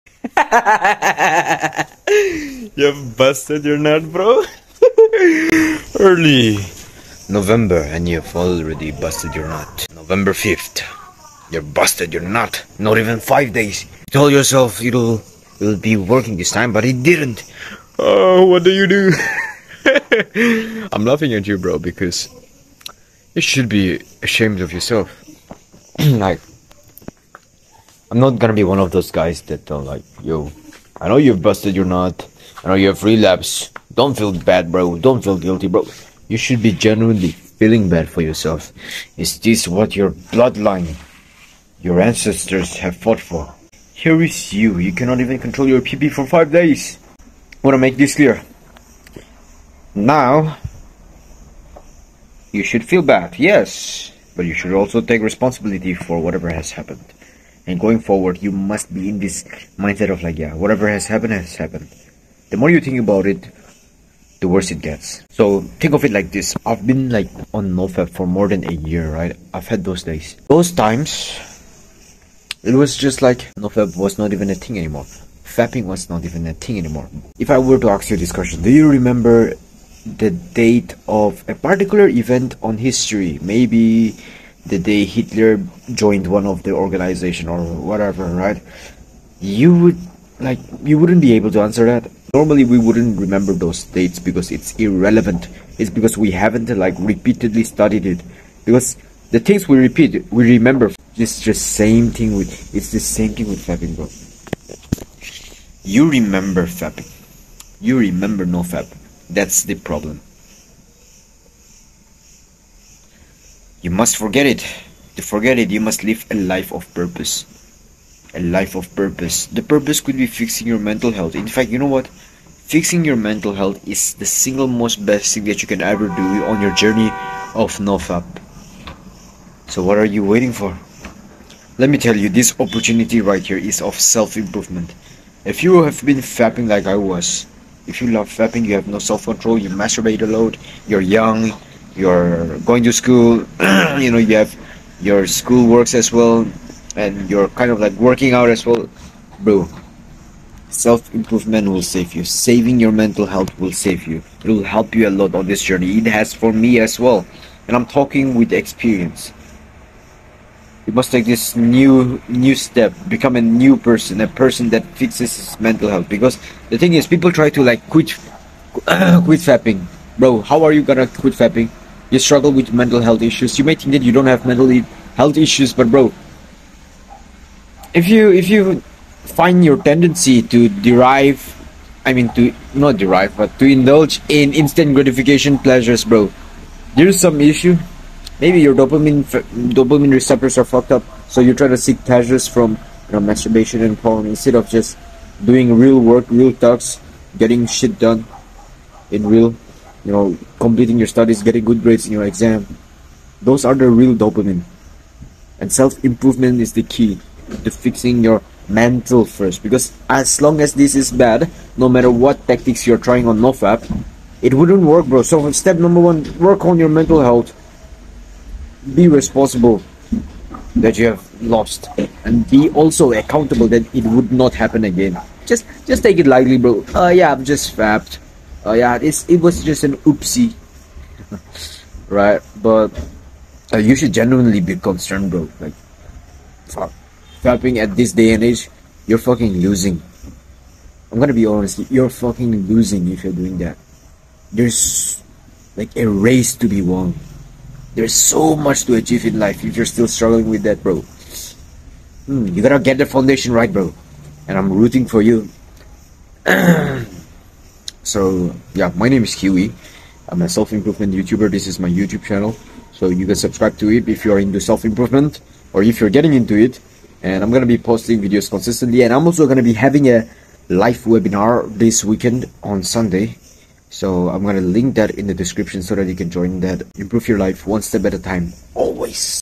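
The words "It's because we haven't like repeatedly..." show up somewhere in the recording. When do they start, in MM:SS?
01:35.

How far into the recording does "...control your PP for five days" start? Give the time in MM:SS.
00:45.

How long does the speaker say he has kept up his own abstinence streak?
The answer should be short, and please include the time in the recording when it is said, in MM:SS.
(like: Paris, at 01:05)
More than a year, at 01:08.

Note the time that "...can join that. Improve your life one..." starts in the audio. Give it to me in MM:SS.
04:36.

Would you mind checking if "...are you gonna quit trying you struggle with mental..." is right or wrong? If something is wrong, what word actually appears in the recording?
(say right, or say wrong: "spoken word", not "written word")
wrong: "fapping", not "trying".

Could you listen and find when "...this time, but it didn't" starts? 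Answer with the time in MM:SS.
00:16.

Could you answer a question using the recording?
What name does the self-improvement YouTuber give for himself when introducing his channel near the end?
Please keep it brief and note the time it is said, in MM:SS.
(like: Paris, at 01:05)
Kewi, at 04:19.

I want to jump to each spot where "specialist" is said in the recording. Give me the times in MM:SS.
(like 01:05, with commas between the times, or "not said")
not said.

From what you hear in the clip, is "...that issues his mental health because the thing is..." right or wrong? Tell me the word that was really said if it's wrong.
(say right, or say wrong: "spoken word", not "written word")
wrong: "fixes", not "issues".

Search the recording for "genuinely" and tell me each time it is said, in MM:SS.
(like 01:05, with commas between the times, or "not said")
00:36, 03:54.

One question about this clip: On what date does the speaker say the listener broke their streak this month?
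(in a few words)
November 5th.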